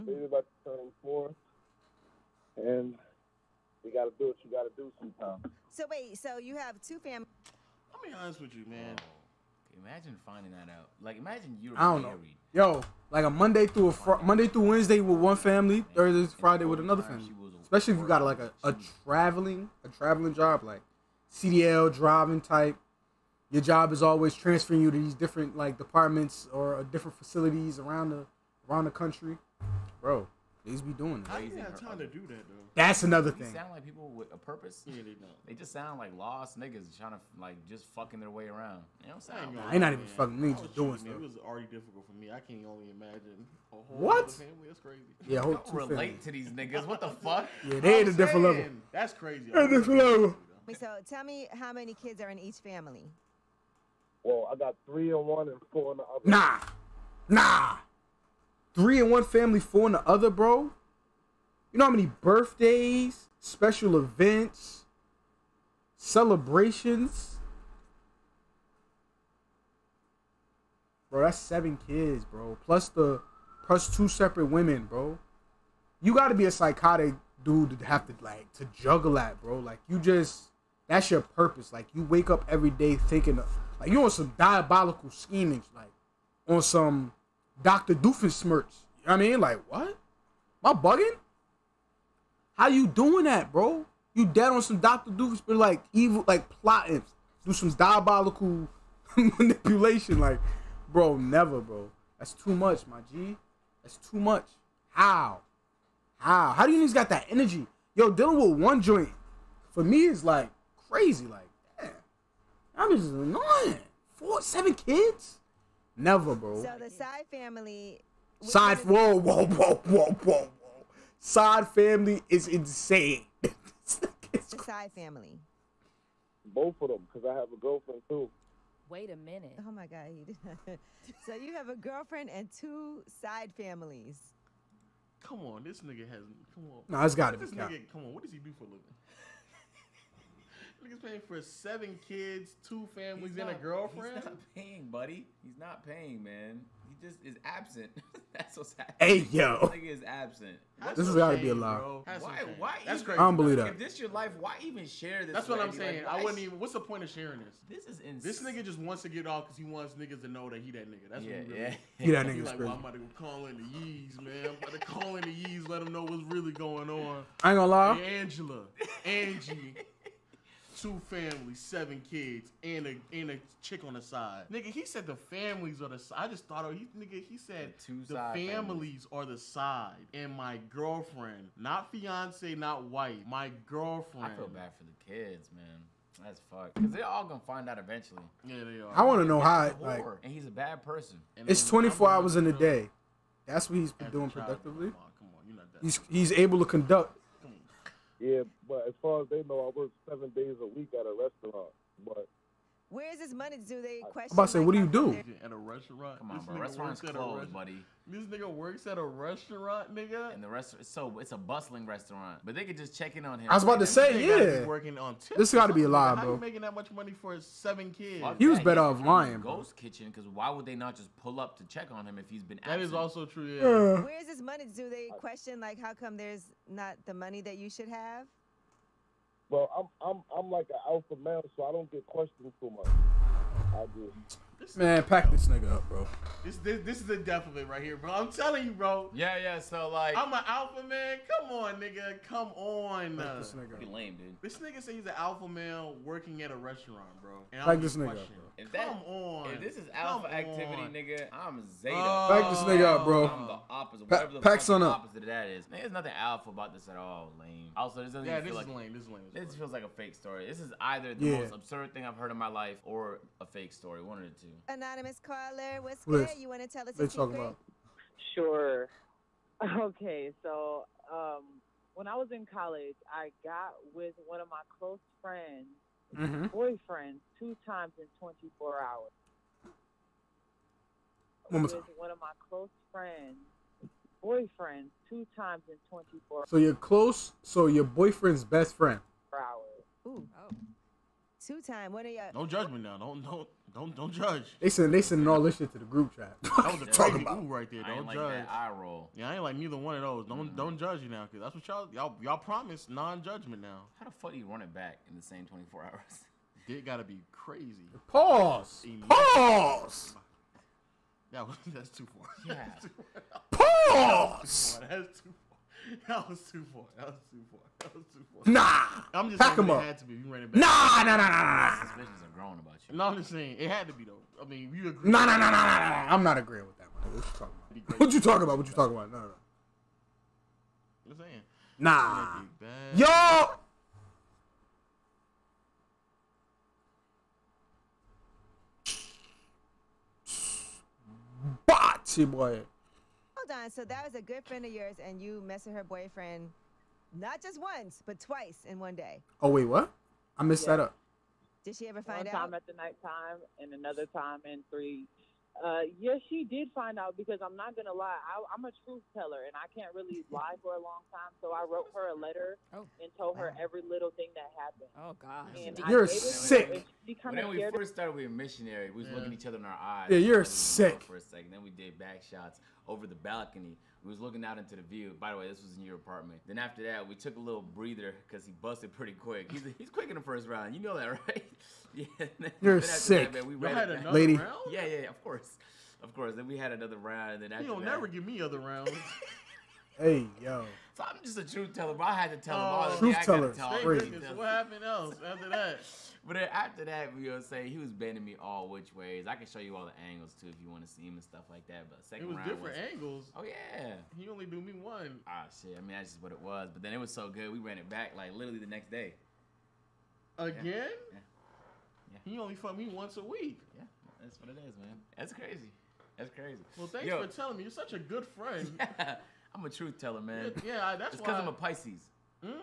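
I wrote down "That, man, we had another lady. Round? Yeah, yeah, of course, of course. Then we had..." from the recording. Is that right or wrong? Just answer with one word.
right.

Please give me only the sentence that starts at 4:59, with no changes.
Yeah, I ain't like neither one of those.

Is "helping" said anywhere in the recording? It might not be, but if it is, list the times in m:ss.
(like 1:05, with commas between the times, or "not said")
not said.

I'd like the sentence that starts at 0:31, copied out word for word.
I ain't have time to do that though.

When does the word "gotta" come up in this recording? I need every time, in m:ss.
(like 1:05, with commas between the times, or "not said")
1:16, 5:06.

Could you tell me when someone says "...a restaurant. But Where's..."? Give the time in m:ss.
3:21.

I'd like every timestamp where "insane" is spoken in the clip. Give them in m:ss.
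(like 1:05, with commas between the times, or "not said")
2:02, 2:38.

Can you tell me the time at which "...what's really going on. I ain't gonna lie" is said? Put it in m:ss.
2:46.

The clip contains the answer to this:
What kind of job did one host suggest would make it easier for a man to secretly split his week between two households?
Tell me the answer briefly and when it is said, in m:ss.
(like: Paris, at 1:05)
CDL driving, at 0:21.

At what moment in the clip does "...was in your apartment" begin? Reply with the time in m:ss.
6:15.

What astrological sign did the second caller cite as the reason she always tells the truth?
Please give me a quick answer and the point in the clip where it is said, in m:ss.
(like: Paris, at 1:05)
Pisces, at 7:01.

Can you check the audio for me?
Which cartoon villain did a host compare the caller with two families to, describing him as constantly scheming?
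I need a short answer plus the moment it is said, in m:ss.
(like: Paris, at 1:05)
Dr. Doofenshmirtz, at 1:27.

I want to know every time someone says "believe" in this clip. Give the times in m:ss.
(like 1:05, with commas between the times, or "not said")
2:33.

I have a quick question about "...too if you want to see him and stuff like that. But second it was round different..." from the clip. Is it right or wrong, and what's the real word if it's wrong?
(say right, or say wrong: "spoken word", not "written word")
right.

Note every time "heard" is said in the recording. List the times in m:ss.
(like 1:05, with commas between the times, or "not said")
4:22.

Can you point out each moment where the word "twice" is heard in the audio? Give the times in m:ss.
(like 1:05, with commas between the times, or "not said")
5:48.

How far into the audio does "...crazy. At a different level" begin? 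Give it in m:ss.
0:49.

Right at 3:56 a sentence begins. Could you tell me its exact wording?
This, this this is the death of it right here, bro.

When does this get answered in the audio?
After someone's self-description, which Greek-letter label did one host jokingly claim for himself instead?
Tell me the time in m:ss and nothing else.
4:11.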